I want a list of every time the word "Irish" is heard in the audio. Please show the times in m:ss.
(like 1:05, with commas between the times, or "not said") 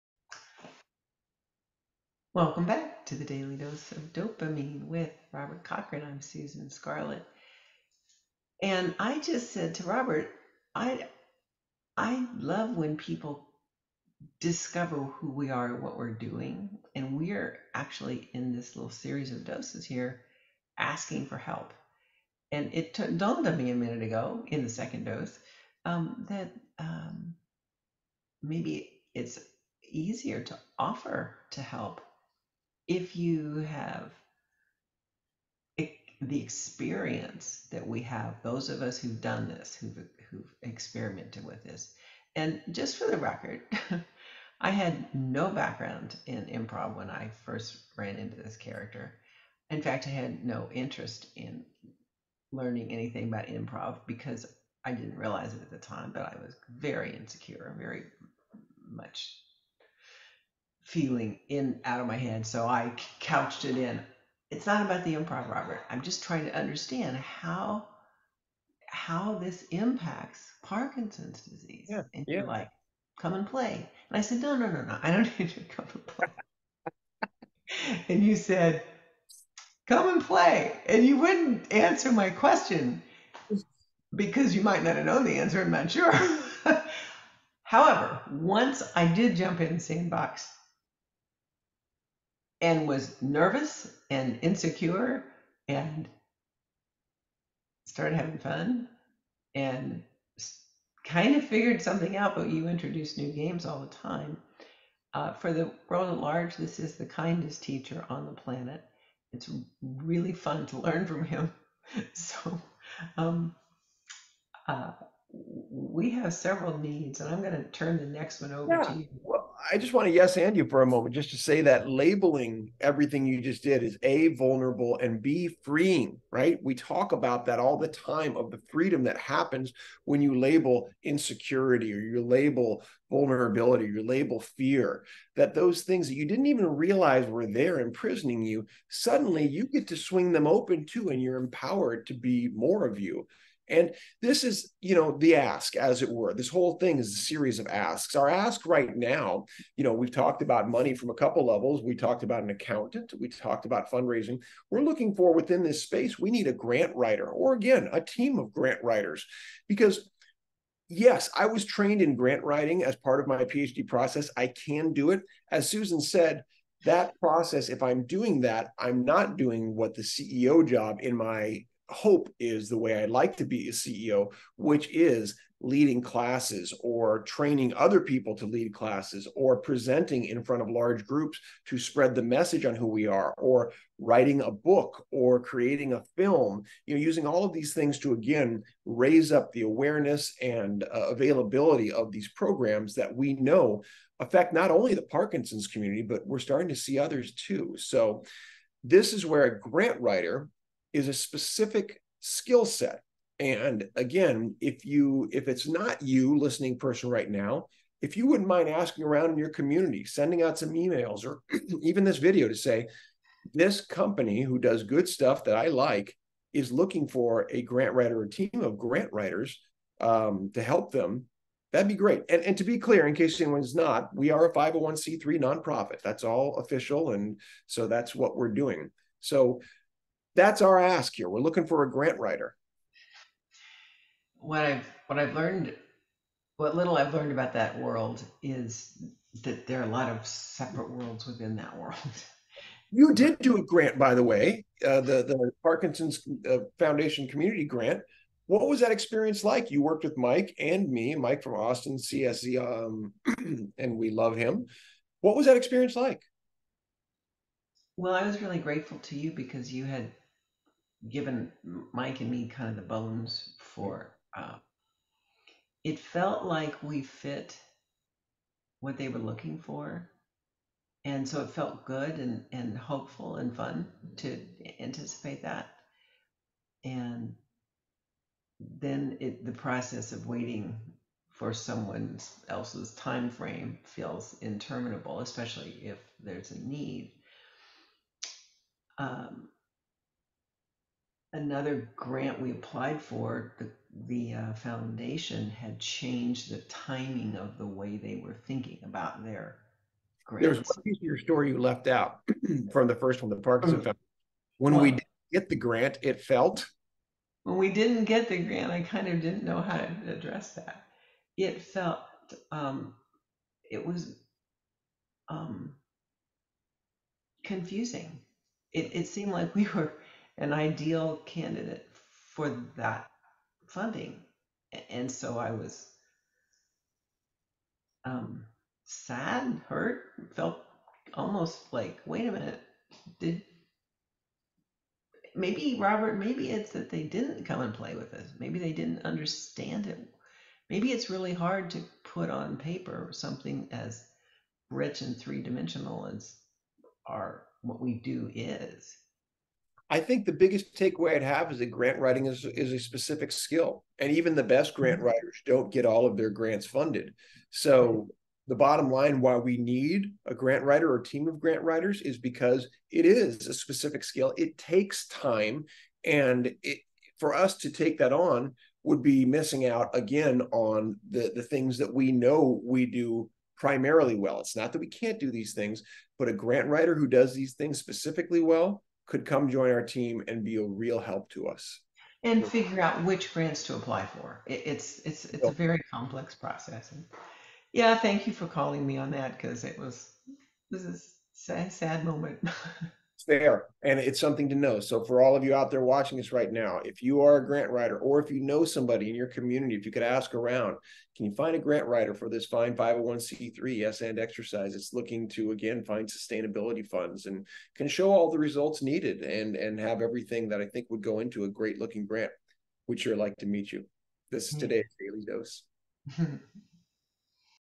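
not said.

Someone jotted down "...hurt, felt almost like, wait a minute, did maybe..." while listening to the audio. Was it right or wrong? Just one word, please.
right.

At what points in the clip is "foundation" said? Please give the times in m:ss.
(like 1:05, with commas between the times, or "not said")
4:06, 4:54, 5:03.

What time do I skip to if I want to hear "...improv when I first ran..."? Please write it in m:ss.
0:46.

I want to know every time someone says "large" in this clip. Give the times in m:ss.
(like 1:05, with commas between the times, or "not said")
1:46, 3:00.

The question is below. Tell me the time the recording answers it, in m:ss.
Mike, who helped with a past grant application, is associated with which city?
4:11.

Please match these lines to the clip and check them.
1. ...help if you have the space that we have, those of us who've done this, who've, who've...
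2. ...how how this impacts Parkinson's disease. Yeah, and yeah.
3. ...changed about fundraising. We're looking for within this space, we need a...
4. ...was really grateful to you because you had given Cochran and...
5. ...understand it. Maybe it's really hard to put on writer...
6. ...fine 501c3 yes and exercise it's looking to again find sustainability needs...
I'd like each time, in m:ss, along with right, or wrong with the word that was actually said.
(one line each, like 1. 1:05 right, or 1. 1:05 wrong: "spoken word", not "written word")
1. 0:31 wrong: "experience", not "space"
2. 1:07 right
3. 2:33 wrong: "talked", not "changed"
4. 4:18 wrong: "Mike", not "Cochran"
5. 5:39 wrong: "paper", not "writer"
6. 6:42 wrong: "funds", not "needs".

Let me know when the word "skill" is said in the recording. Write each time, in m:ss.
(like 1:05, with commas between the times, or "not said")
3:22, 5:53, 6:04.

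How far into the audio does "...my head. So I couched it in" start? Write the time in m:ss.
1:02.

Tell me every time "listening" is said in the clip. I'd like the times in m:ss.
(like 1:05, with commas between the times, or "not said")
3:26.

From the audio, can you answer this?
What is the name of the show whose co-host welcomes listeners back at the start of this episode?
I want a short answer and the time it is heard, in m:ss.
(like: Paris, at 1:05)
Daily Dose of Dopamine, at 0:03.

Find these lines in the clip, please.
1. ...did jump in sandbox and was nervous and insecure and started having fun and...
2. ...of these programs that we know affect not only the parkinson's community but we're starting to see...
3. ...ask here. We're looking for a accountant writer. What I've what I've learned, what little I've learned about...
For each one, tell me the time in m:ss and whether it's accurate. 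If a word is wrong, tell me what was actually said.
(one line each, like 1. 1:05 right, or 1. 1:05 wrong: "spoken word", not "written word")
1. 1:29 right
2. 3:11 right
3. 3:50 wrong: "grant", not "accountant".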